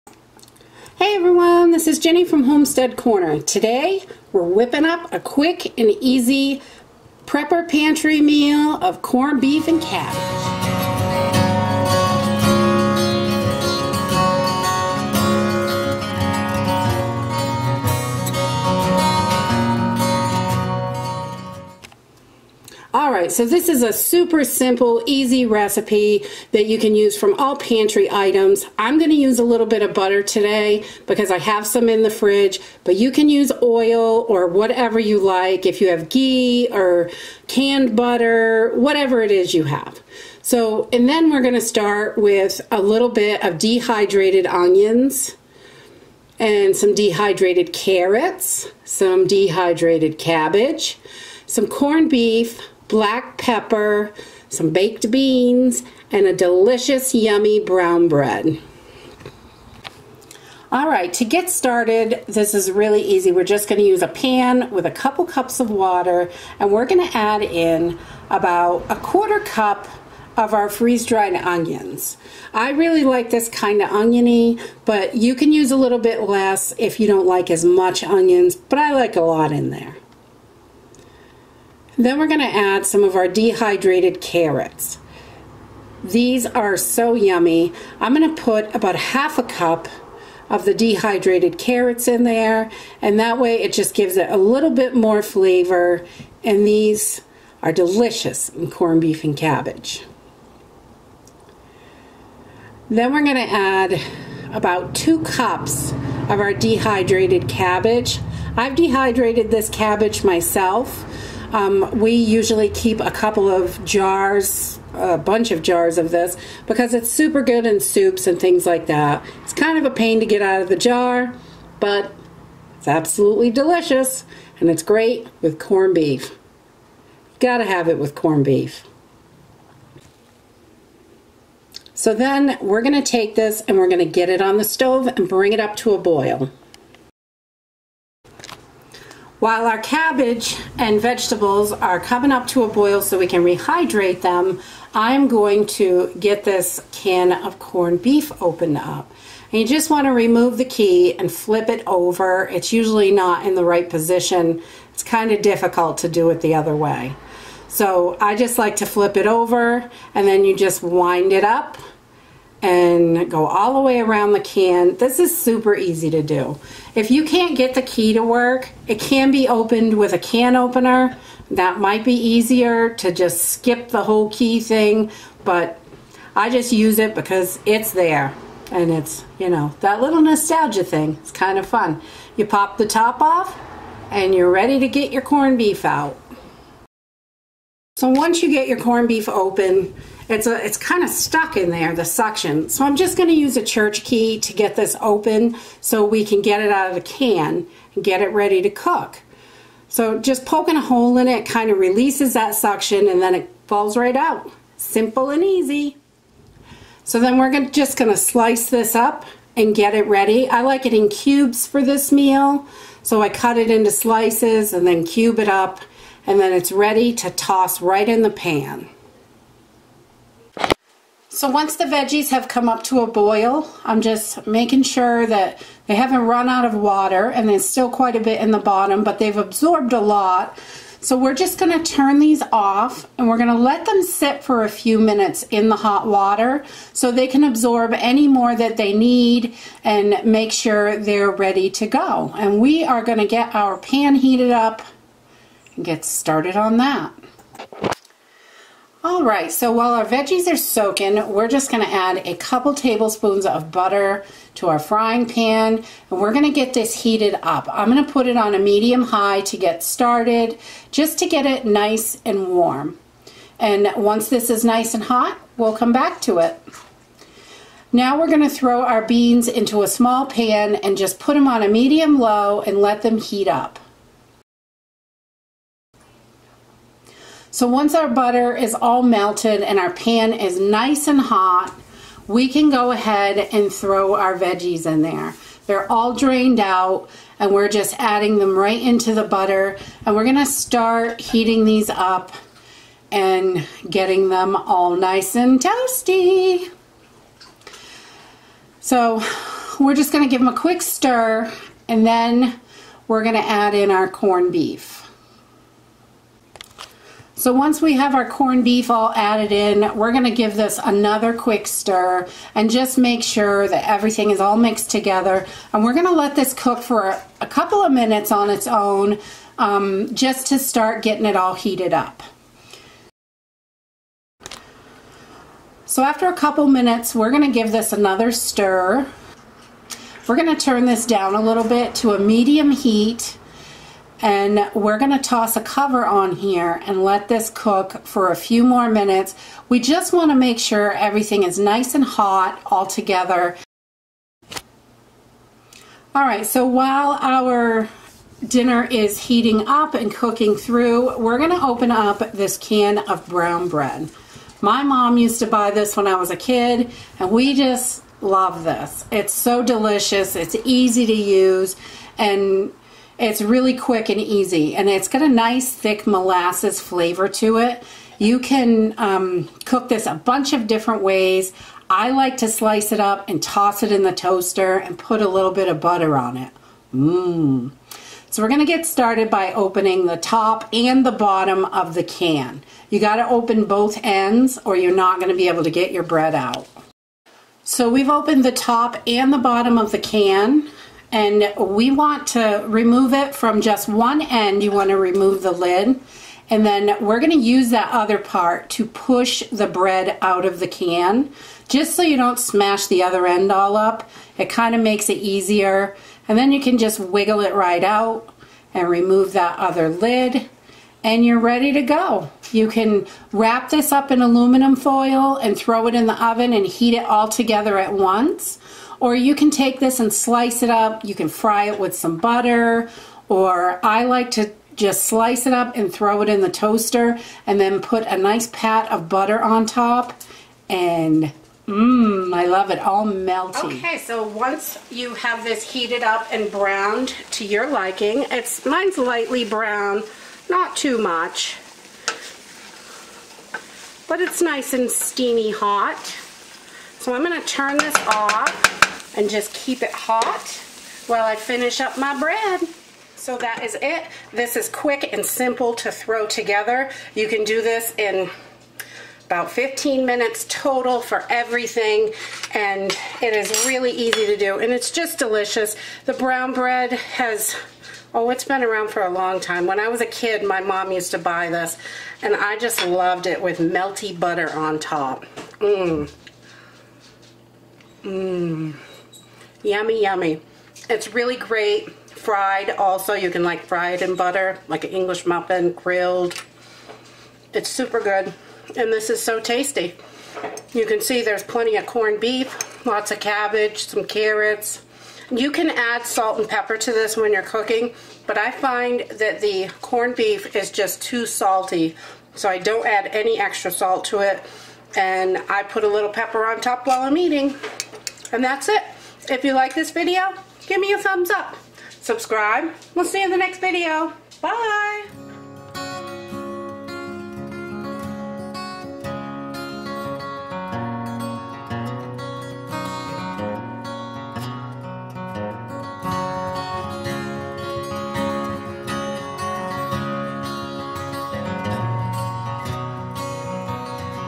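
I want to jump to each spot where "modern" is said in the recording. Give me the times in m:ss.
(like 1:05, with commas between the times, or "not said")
not said.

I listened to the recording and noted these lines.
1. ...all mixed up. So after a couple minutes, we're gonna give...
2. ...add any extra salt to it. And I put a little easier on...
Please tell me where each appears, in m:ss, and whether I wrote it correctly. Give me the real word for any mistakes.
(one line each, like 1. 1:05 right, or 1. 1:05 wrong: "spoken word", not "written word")
1. 5:21 wrong: "heated", not "mixed"
2. 8:22 wrong: "pepper", not "easier".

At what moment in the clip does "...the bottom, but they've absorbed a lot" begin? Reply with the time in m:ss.
3:48.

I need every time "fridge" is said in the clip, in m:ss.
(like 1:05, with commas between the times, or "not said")
0:32.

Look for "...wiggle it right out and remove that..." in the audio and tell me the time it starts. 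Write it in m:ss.
6:46.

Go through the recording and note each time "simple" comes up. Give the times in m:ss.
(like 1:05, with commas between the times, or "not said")
0:24, 3:24, 7:35.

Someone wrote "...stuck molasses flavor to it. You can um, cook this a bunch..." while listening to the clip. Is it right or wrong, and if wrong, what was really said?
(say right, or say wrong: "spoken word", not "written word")
wrong: "thick", not "stuck".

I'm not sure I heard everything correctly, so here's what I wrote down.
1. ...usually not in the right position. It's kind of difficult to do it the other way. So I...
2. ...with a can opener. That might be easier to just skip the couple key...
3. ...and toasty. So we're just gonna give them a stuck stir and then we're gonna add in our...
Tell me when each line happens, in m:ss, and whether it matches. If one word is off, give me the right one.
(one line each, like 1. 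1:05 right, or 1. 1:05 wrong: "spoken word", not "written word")
1. 2:32 right
2. 2:49 wrong: "whole", not "couple"
3. 4:55 wrong: "quick", not "stuck".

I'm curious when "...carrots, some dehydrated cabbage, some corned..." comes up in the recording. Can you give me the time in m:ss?
0:47.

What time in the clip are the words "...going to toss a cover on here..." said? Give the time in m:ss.
5:34.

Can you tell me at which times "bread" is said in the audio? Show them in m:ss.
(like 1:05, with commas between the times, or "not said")
0:58, 5:53, 6:26, 6:39, 7:32, 7:46.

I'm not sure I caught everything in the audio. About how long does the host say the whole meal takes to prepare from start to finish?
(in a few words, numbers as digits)
15 minutes.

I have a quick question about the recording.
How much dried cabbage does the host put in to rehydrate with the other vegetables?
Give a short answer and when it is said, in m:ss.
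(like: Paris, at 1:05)
2 cups, at 1:44.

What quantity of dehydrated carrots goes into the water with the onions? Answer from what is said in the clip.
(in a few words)
half a cup.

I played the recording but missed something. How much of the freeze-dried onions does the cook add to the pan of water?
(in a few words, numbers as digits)
a quarter cup.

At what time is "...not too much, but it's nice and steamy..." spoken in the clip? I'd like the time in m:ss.
7:20.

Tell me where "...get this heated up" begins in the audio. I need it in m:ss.
4:16.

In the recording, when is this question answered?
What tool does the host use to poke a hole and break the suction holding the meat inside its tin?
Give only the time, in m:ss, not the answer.
3:13.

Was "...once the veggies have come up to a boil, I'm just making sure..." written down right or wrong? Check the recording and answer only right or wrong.
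right.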